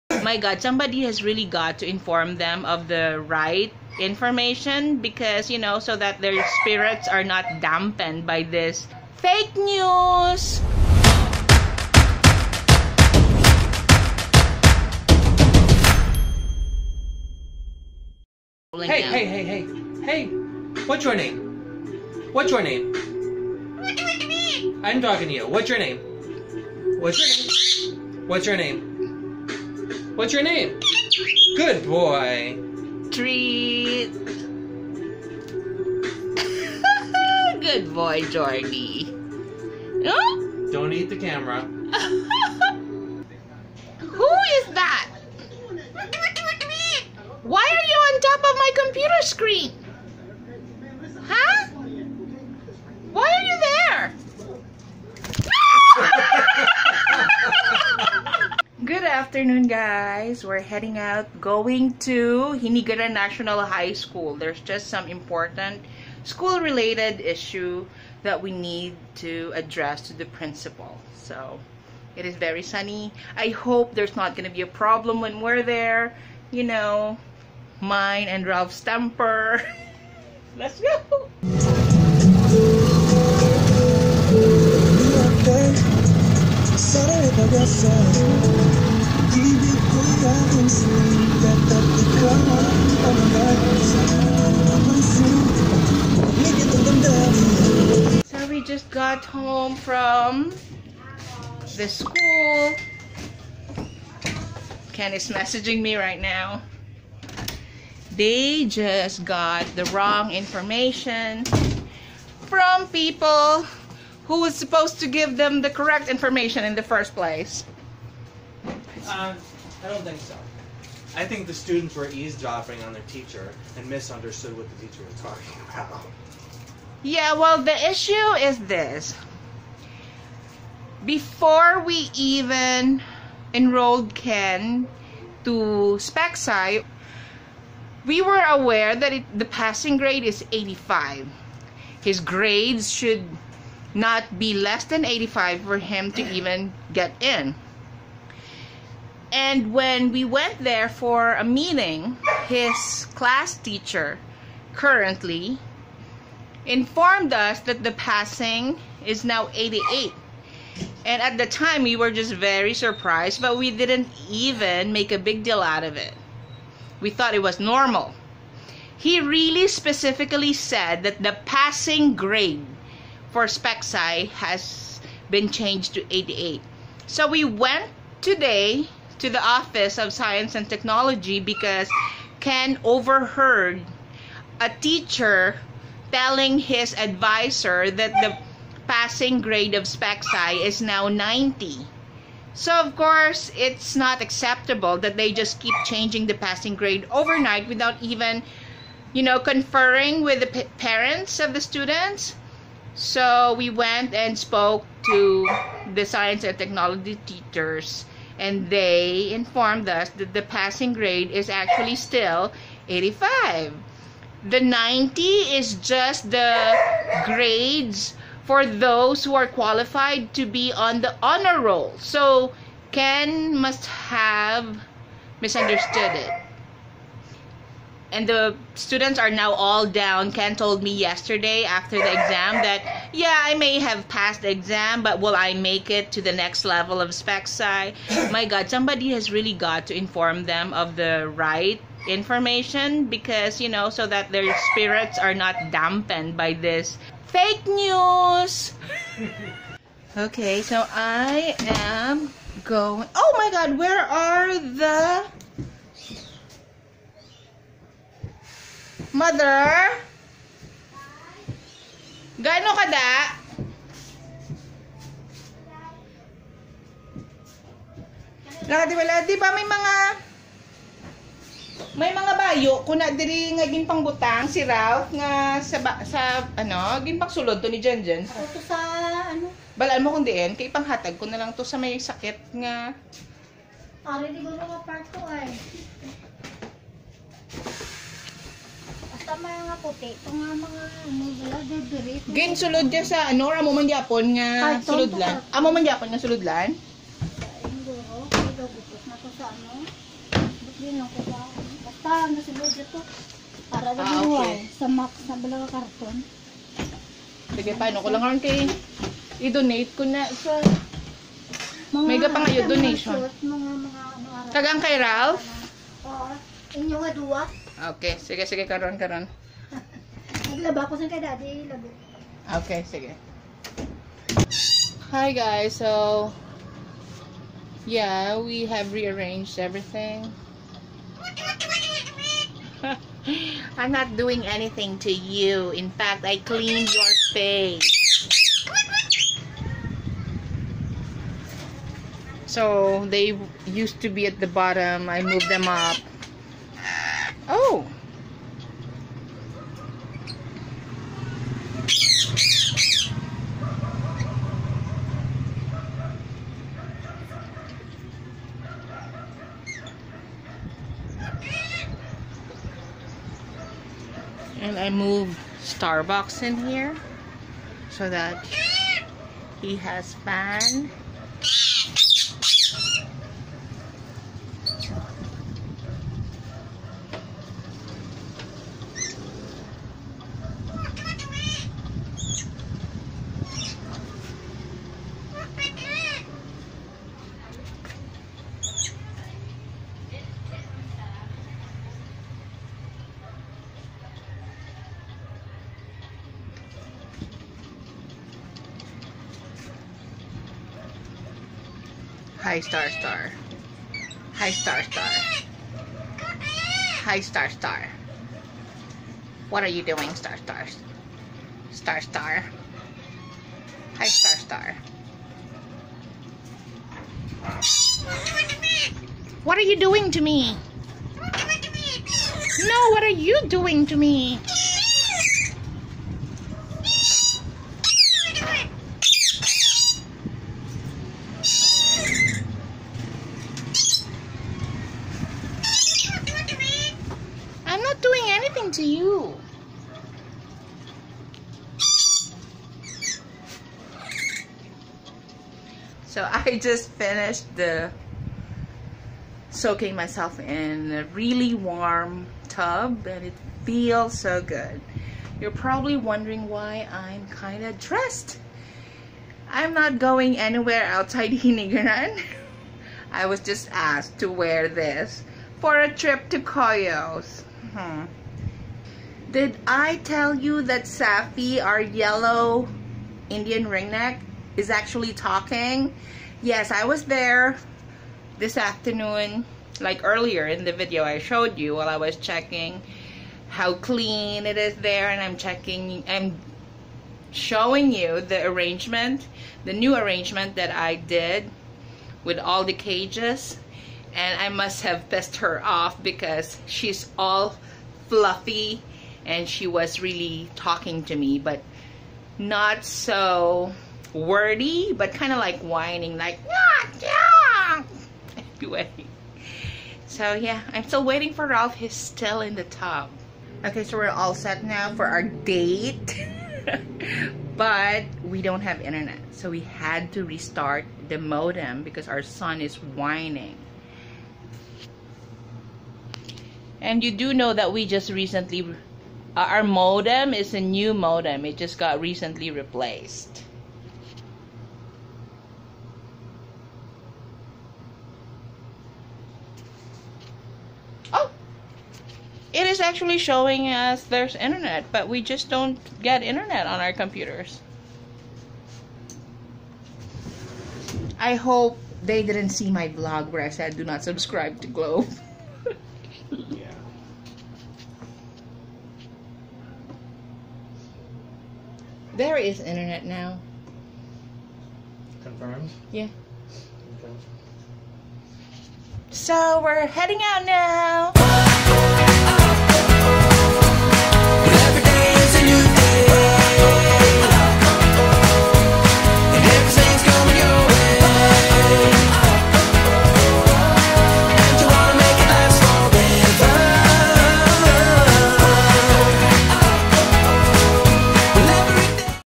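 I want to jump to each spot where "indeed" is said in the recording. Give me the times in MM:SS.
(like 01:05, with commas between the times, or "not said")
not said.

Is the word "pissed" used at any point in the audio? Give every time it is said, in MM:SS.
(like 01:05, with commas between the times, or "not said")
08:15.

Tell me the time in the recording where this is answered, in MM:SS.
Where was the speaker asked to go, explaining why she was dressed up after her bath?
07:46.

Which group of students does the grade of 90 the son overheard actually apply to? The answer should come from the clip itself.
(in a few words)
honor roll.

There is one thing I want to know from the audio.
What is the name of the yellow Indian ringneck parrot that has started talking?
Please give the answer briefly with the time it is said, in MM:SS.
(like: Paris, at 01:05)
Safi, at 07:50.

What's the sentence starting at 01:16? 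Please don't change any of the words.
You know, mine and Ralph's temper.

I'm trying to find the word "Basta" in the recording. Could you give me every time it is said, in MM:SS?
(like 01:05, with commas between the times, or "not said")
05:01.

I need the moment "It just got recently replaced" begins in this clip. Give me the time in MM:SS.
08:51.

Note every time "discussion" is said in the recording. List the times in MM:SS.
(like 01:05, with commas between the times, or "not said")
not said.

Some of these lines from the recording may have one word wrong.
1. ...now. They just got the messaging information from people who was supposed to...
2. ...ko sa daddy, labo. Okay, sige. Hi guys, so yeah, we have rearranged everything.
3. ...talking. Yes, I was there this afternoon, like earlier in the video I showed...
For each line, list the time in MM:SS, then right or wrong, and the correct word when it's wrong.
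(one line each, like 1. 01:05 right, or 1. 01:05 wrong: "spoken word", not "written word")
1. 01:46 wrong: "wrong", not "messaging"
2. 05:20 right
3. 07:55 right.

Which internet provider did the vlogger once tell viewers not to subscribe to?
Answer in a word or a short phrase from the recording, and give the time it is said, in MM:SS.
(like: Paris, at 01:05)
Globe, at 09:14.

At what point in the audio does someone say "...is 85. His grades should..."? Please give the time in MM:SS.
02:20.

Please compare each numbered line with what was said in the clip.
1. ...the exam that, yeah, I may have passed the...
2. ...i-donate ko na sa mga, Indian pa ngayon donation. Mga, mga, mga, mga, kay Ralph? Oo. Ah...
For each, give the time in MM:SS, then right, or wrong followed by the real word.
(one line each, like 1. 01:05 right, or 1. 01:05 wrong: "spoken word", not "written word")
1. 03:51 right
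2. 05:09 wrong: "Mega", not "Indian".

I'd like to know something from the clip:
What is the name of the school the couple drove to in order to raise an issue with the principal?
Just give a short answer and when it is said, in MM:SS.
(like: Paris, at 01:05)
Hinigaran National High School, at 01:02.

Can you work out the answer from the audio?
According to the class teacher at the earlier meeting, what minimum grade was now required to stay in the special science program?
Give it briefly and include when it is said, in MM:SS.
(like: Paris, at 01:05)
88, at 02:39.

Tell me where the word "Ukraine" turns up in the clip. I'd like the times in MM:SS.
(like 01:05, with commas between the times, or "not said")
not said.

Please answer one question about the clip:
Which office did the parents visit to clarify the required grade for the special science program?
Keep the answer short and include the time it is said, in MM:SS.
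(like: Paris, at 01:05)
Office of Science and Technology, at 02:59.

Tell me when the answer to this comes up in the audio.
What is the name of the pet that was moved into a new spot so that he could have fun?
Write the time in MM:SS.
06:05.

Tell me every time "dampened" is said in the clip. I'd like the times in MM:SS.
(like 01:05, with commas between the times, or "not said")
00:07, 04:05.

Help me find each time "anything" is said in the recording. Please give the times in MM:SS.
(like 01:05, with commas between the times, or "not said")
05:34.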